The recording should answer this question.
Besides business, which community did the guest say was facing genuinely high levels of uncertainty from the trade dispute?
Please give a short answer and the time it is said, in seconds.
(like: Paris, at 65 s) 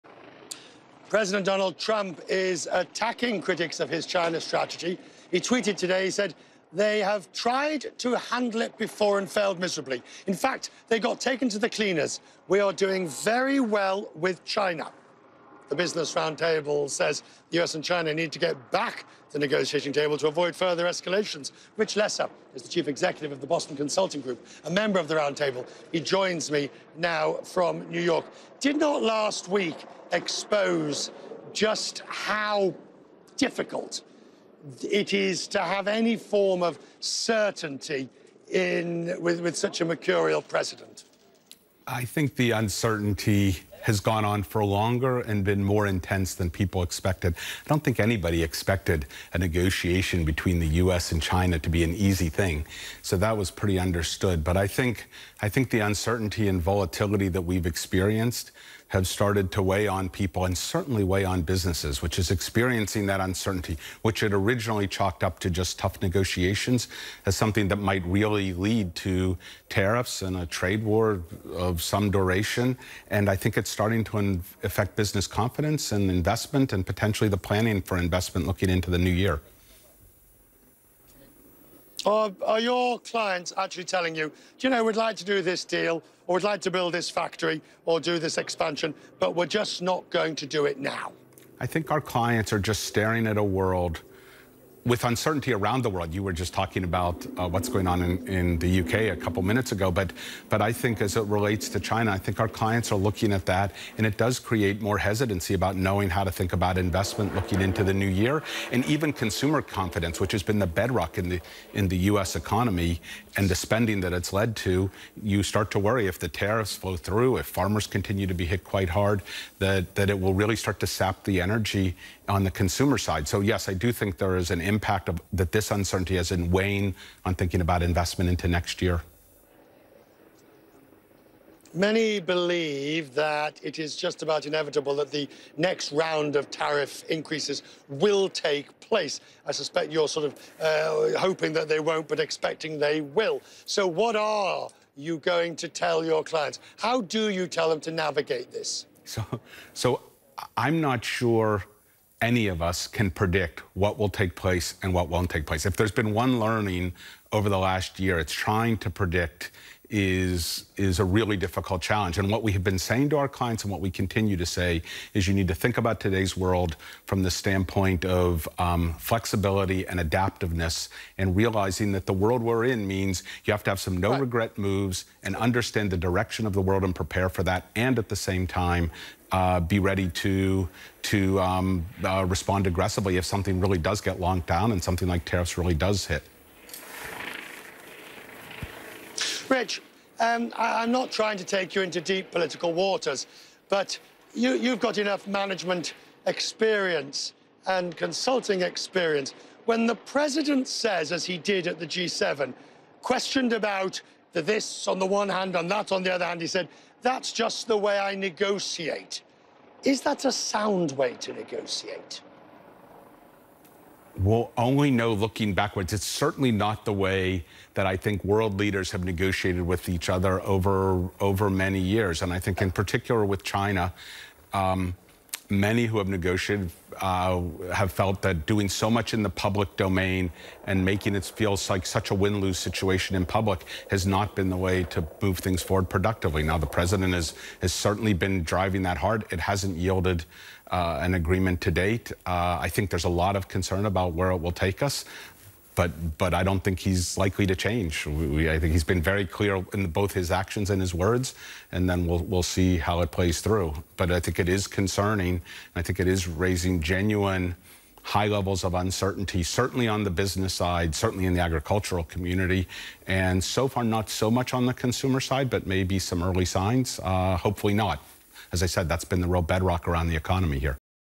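agricultural community, at 261 s.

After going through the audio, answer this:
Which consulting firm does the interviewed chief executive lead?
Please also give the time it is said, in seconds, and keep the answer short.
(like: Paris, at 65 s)
Boston Consulting Group, at 23 s.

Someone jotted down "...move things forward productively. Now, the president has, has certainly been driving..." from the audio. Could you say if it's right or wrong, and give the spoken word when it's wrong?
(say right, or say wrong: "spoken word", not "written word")
right.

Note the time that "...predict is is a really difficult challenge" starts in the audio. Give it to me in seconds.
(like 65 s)
158 s.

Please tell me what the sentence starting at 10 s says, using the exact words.
In fact, they got taken to the cleaners.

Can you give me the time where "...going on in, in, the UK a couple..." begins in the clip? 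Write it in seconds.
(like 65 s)
97 s.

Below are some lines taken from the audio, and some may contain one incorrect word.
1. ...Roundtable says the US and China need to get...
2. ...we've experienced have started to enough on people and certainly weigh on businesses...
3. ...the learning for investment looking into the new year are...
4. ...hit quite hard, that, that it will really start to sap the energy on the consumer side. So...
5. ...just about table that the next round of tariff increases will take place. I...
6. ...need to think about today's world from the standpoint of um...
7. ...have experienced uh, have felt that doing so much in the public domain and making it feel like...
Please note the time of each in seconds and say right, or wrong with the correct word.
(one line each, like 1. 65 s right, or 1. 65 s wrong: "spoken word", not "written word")
1. 16 s right
2. 57 s wrong: "weigh", not "enough"
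3. 77 s wrong: "planning", not "learning"
4. 118 s right
5. 133 s wrong: "inevitable", not "table"
6. 165 s right
7. 225 s wrong: "negotiated", not "experienced".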